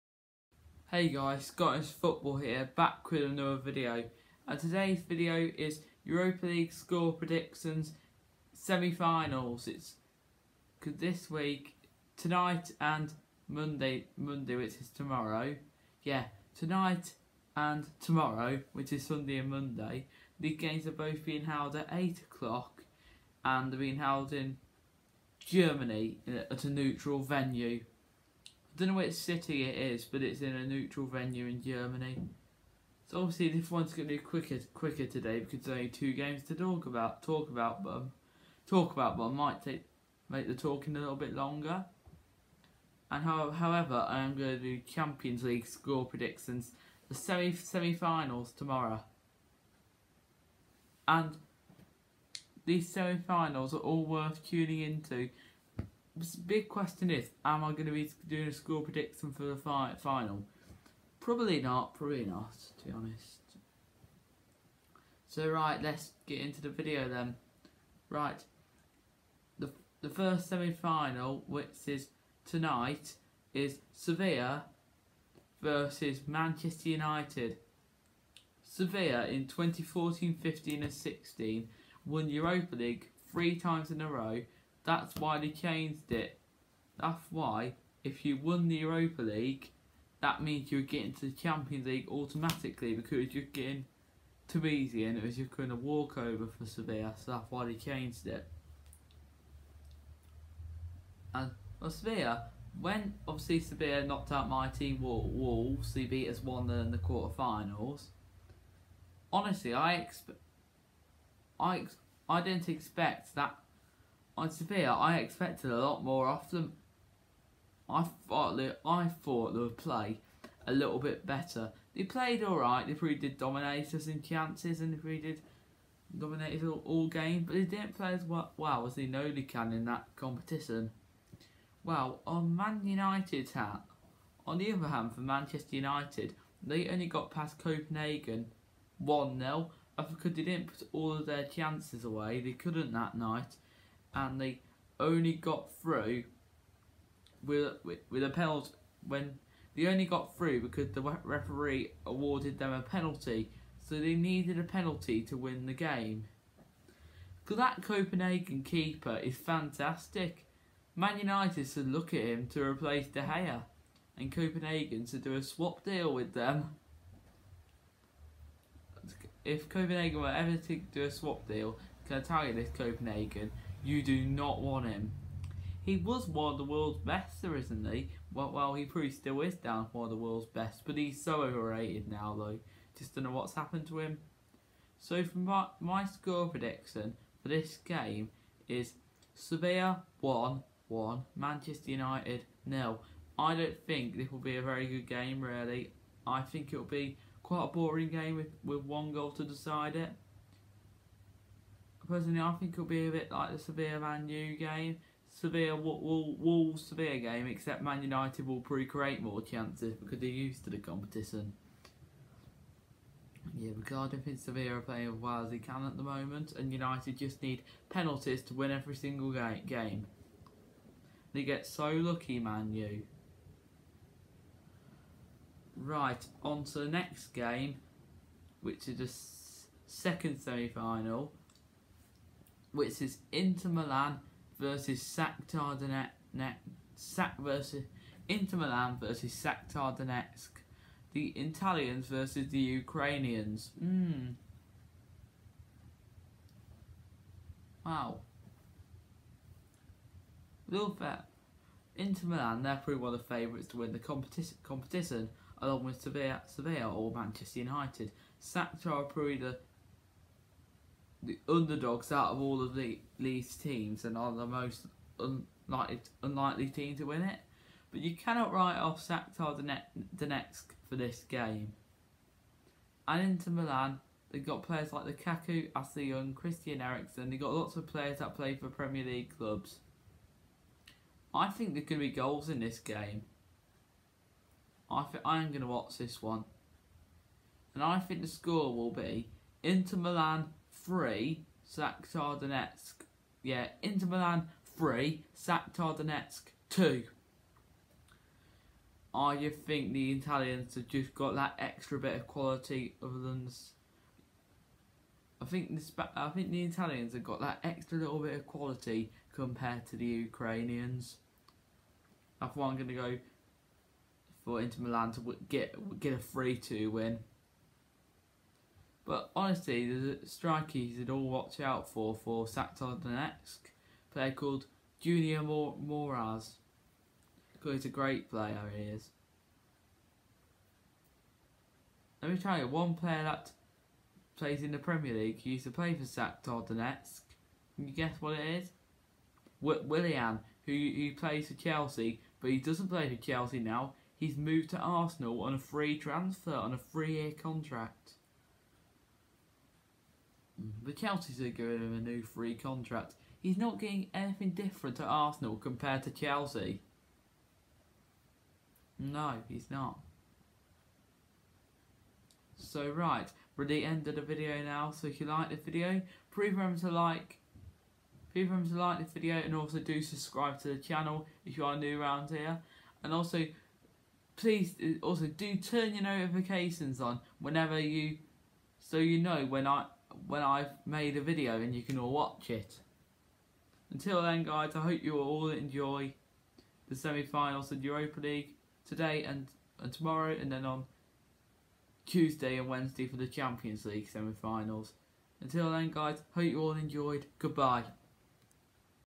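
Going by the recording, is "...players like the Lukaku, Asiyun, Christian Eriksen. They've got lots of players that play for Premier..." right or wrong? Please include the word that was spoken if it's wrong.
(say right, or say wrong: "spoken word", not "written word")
right.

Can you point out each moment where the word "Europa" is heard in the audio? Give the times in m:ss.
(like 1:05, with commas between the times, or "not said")
0:06, 1:22, 1:28, 6:27.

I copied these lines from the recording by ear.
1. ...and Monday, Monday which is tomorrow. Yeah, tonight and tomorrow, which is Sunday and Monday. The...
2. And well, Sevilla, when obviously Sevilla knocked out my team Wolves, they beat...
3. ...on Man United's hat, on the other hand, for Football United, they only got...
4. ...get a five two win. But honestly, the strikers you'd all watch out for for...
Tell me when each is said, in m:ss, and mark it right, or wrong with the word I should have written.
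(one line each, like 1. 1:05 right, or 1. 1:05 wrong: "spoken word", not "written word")
1. 0:12 right
2. 1:41 right
3. 2:12 wrong: "Manchester", not "Football"
4. 5:15 wrong: "three", not "five".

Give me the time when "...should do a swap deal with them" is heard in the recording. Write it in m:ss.
2:45.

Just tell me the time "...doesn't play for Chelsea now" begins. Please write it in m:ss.
5:42.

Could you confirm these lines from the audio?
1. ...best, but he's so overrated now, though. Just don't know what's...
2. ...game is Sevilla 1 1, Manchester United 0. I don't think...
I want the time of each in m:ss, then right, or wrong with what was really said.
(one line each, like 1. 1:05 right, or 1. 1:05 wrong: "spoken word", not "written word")
1. 3:00 right
2. 3:07 right.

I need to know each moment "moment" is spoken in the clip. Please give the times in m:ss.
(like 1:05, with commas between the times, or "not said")
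3:36.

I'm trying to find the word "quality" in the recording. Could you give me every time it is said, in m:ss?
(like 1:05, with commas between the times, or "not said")
5:02, 5:08.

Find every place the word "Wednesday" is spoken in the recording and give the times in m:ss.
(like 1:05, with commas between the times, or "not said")
6:32.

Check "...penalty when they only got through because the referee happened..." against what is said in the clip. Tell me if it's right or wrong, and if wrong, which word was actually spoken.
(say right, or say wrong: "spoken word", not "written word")
wrong: "awarded", not "happened".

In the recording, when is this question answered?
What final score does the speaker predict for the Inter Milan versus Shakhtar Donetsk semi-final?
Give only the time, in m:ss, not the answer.
4:53.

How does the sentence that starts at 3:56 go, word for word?
Sac versus Inter Milan versus Shakhtar Donetsk.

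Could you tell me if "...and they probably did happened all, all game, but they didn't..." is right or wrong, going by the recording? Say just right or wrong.
wrong.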